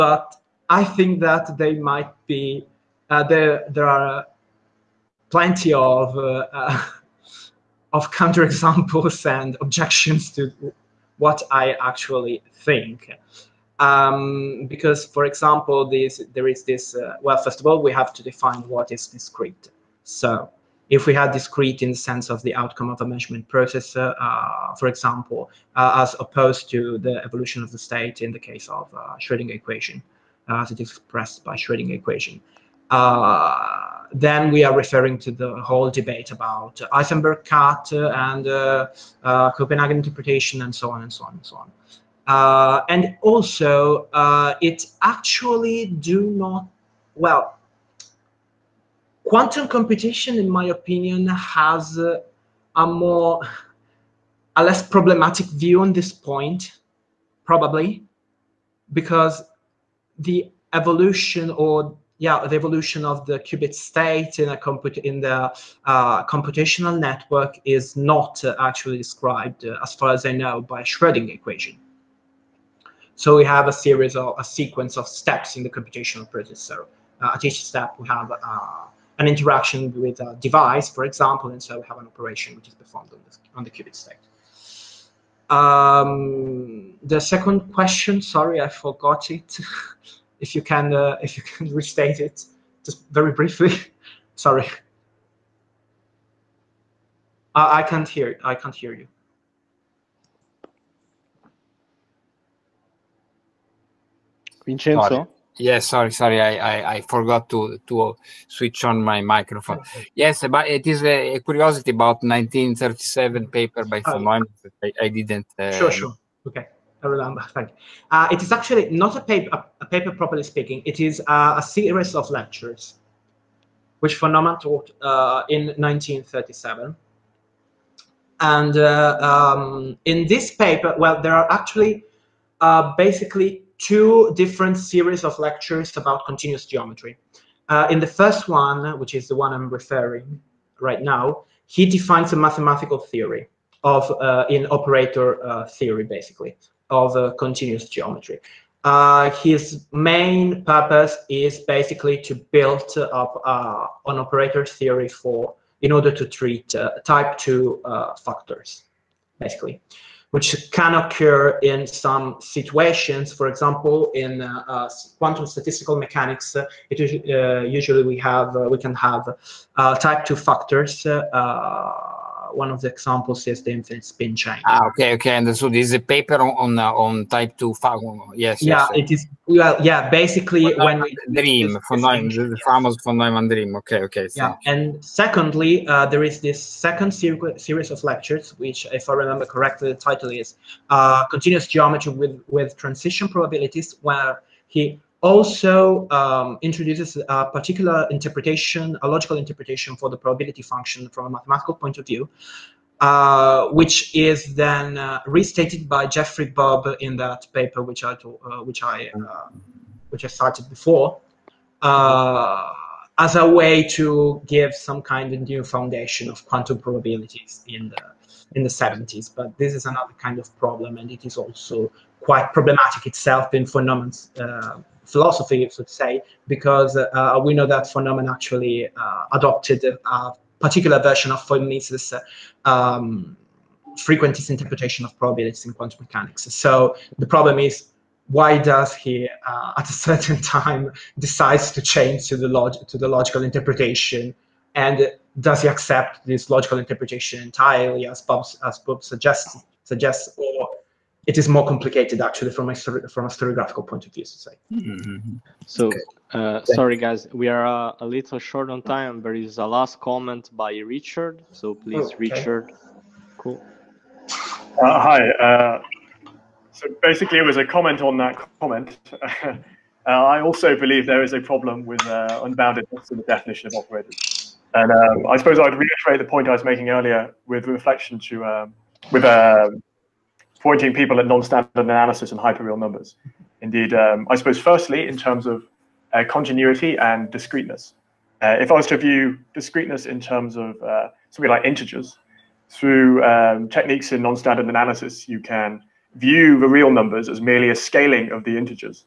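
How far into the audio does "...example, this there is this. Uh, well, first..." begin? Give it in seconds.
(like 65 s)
15 s.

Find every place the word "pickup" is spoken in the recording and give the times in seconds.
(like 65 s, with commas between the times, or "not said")
not said.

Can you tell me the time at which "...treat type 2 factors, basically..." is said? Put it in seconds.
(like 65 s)
156 s.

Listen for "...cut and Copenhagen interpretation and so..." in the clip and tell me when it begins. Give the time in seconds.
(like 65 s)
37 s.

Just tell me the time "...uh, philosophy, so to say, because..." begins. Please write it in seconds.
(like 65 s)
224 s.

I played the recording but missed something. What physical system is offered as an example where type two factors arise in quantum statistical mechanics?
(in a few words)
infinite spin chain.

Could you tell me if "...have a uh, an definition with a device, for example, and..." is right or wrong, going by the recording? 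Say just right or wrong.
wrong.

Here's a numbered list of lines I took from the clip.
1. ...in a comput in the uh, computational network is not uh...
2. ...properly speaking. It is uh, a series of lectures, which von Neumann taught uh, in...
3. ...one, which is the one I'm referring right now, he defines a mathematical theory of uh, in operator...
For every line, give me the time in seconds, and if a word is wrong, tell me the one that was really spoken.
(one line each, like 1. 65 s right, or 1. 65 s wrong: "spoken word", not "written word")
1. 64 s right
2. 120 s right
3. 138 s right.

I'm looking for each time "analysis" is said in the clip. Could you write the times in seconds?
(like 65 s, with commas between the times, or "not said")
281 s, 294 s.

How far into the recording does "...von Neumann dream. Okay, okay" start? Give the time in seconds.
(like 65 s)
183 s.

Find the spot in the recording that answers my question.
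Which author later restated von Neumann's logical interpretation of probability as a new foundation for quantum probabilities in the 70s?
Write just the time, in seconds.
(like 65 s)
206 s.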